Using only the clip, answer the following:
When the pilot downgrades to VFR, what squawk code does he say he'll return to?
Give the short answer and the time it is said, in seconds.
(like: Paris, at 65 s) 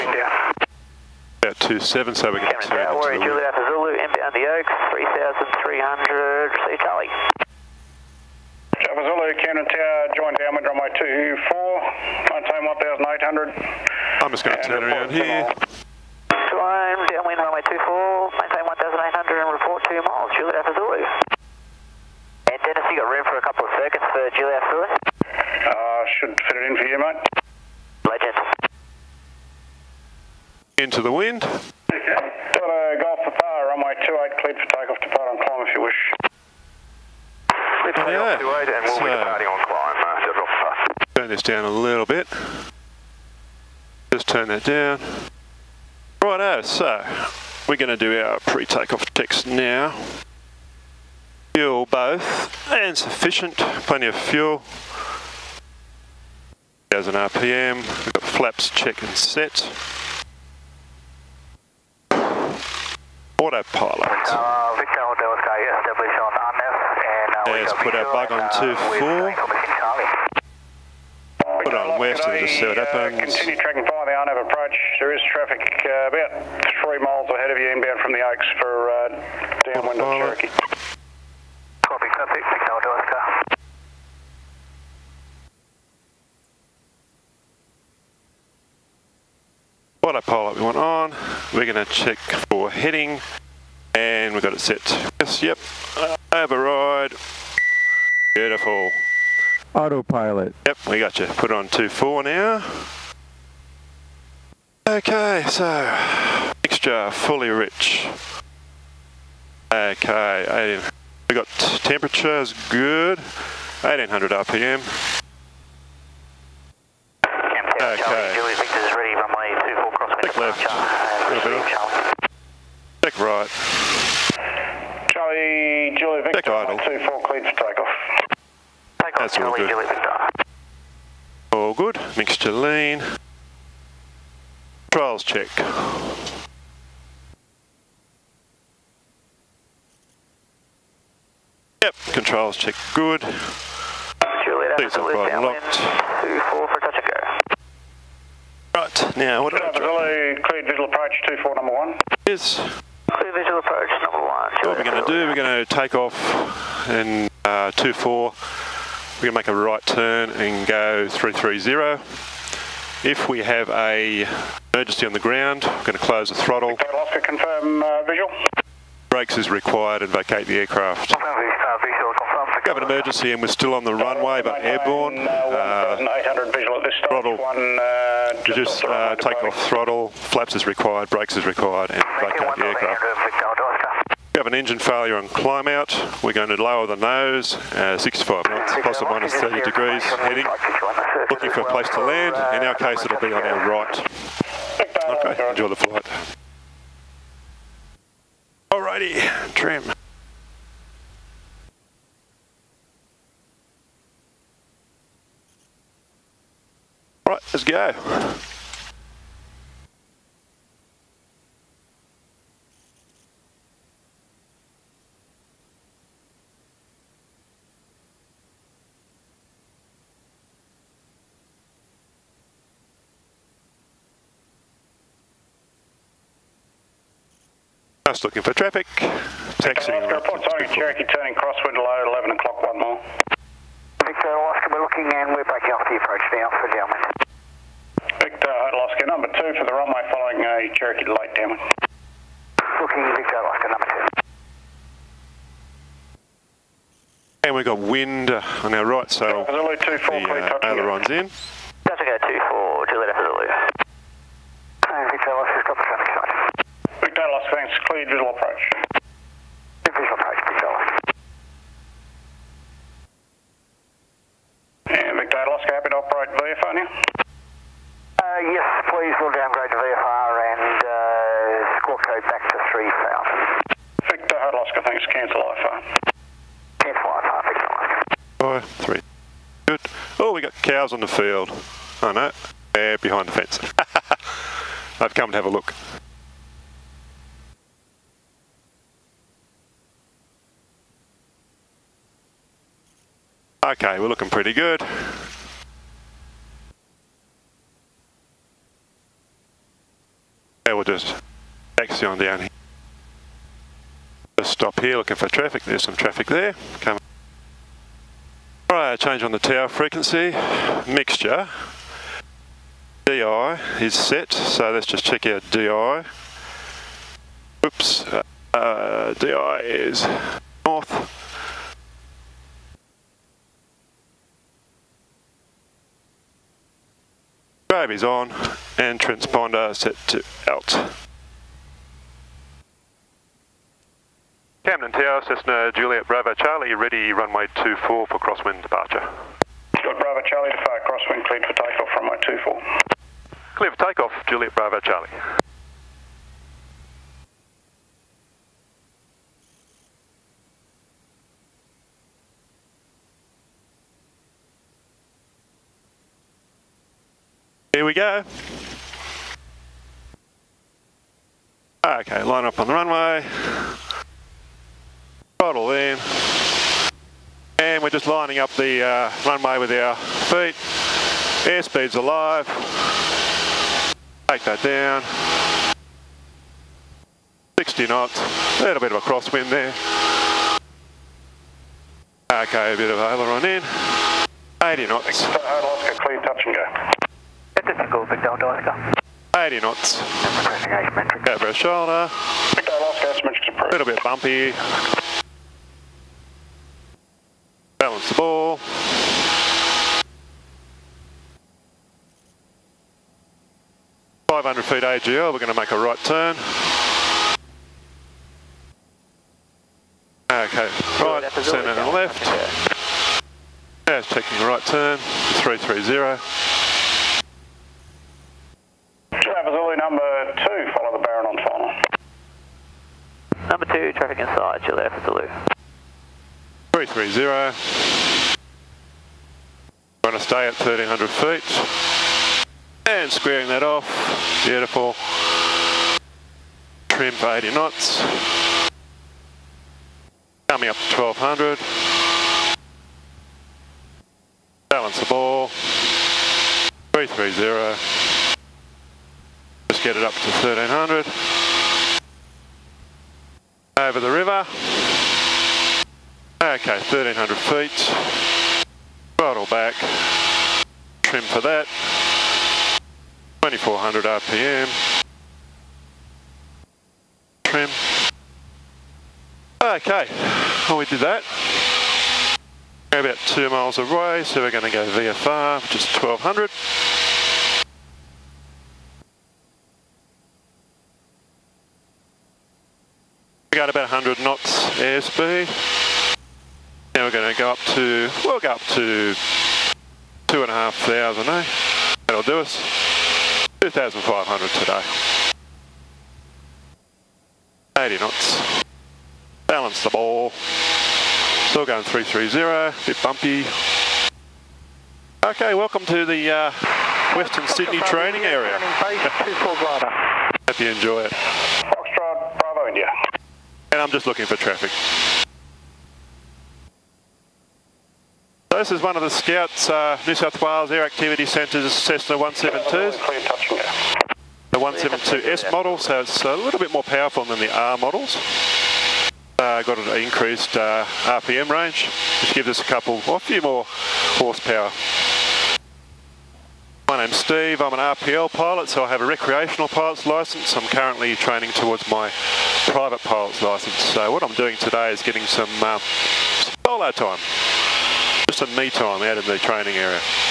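3000, at 272 s.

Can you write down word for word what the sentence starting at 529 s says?
Uh, got an increased uh, RPM range, which gives us a couple, or a few more horsepower.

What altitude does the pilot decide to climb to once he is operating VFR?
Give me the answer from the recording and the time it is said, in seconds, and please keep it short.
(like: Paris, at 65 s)
2,500 feet, at 493 s.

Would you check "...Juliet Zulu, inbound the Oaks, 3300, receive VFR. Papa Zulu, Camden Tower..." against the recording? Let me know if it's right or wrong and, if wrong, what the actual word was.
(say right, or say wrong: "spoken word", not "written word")
wrong: "Charlie", not "VFR".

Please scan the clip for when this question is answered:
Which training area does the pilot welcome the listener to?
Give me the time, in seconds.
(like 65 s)
507 s.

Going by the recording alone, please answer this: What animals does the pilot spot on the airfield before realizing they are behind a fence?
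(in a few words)
Cows.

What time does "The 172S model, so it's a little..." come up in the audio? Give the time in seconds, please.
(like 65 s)
524 s.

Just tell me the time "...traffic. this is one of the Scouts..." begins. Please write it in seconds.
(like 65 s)
514 s.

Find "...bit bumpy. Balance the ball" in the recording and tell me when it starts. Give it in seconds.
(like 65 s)
393 s.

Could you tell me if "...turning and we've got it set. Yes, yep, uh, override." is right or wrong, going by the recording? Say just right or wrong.
wrong.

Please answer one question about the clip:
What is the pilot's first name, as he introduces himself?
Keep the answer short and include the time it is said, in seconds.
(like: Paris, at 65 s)
Steve, at 537 s.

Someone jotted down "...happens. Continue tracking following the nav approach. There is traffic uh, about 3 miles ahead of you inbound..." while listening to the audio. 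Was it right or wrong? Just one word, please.
right.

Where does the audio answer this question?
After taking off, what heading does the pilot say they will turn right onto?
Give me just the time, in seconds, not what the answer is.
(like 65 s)
160 s.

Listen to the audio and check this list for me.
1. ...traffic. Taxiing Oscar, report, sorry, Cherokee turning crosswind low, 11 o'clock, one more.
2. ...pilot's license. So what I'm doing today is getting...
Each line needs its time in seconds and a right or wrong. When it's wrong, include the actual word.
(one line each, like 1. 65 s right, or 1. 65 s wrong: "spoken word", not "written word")
1. 228 s right
2. 542 s right.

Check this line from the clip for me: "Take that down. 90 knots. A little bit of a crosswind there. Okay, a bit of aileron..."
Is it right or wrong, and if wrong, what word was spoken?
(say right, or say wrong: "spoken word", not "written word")
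wrong: "60", not "90".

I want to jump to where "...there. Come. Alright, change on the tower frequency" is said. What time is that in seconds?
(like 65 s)
306 s.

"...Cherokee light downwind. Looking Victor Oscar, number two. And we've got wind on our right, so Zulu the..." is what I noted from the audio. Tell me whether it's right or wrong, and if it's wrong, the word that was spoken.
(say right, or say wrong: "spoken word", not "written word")
right.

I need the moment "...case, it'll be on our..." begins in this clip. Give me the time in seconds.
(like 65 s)
192 s.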